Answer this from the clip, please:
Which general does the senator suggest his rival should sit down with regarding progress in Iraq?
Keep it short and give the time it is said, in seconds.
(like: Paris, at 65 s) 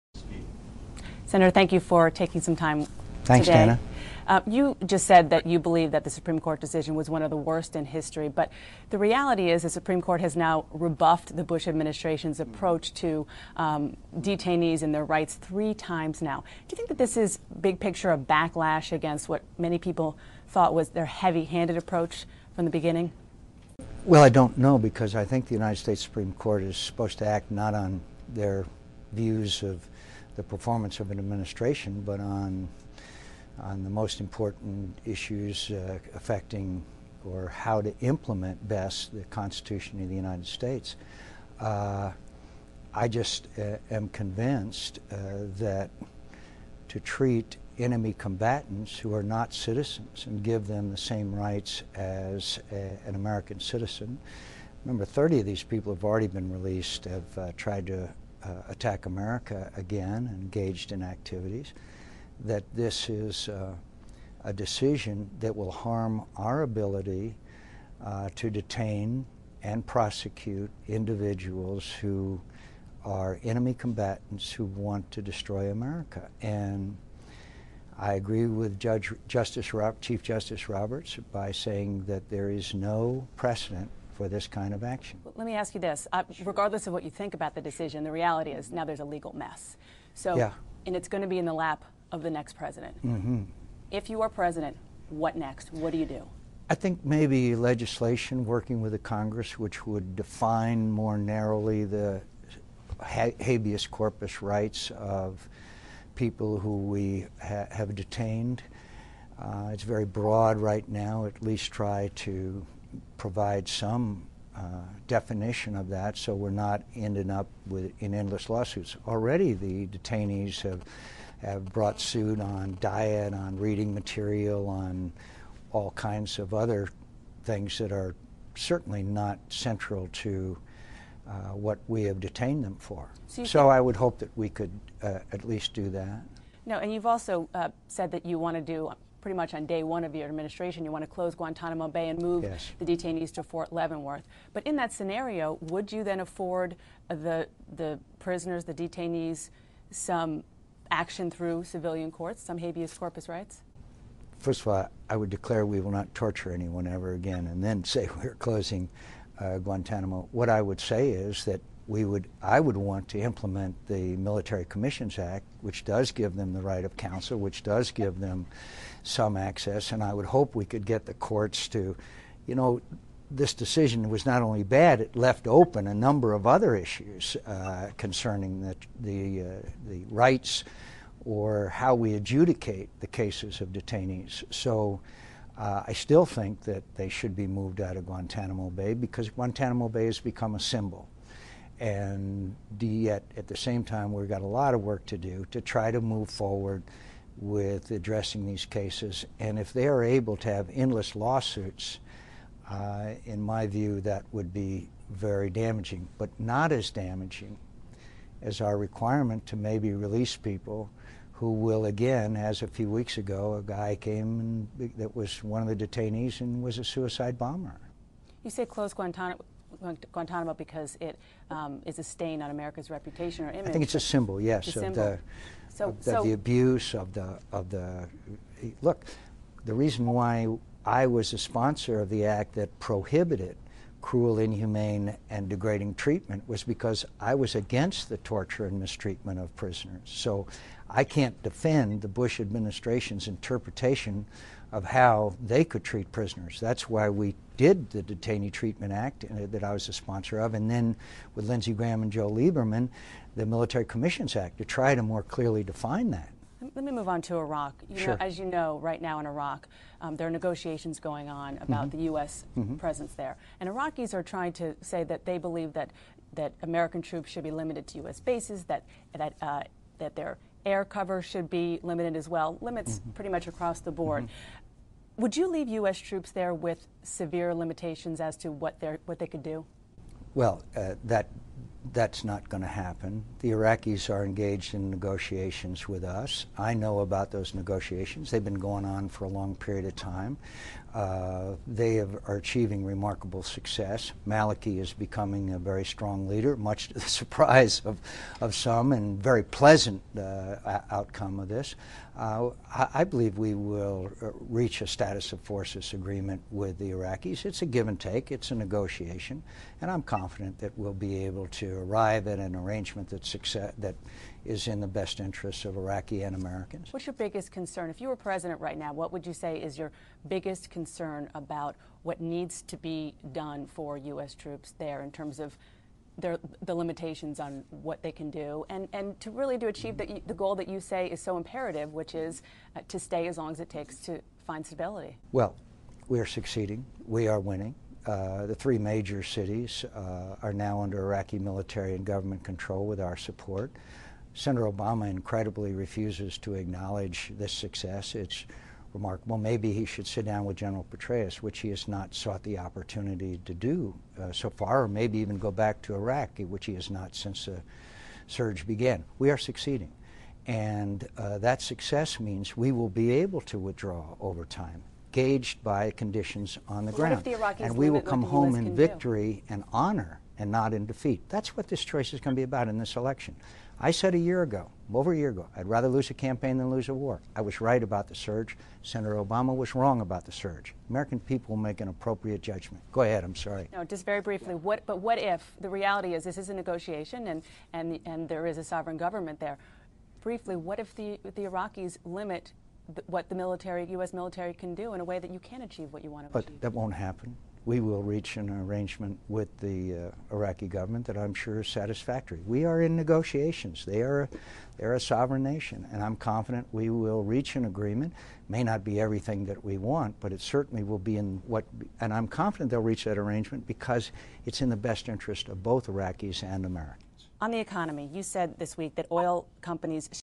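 General Petraeus, at 350 s.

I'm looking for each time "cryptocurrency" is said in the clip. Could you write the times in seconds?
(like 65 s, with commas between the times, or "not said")
not said.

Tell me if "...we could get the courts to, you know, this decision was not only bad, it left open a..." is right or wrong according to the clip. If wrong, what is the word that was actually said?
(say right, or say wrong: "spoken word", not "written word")
right.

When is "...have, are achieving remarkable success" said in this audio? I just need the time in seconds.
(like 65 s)
291 s.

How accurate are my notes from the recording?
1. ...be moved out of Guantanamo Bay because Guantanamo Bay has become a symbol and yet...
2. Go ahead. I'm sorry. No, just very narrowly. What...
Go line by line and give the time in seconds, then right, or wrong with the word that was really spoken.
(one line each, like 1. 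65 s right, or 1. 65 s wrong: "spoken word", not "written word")
1. 187 s right
2. 382 s wrong: "briefly", not "narrowly".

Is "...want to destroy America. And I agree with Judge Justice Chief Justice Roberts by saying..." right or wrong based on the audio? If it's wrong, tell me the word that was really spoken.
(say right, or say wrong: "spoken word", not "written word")
right.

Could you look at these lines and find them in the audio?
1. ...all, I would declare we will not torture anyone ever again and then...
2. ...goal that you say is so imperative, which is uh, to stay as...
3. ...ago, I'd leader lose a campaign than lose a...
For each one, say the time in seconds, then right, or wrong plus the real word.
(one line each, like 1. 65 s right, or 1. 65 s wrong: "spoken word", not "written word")
1. 154 s right
2. 330 s right
3. 375 s wrong: "rather", not "leader".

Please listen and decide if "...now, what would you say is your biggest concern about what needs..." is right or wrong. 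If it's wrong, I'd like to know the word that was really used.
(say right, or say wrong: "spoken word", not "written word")
right.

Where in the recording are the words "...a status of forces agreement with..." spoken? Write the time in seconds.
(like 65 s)
304 s.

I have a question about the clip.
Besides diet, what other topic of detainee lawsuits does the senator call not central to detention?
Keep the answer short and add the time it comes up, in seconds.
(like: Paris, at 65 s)
reading material, at 123 s.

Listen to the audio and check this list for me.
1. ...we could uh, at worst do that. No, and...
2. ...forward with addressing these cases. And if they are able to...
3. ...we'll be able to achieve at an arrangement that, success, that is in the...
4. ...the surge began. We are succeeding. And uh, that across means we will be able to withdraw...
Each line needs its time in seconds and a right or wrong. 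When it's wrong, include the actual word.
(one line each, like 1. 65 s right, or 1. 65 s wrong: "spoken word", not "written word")
1. 134 s wrong: "least", not "worst"
2. 196 s right
3. 310 s wrong: "arrive", not "achieve"
4. 357 s wrong: "success", not "across".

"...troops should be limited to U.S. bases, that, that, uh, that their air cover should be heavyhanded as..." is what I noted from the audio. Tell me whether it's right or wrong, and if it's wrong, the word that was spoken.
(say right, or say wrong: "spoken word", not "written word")
wrong: "limited", not "heavyhanded".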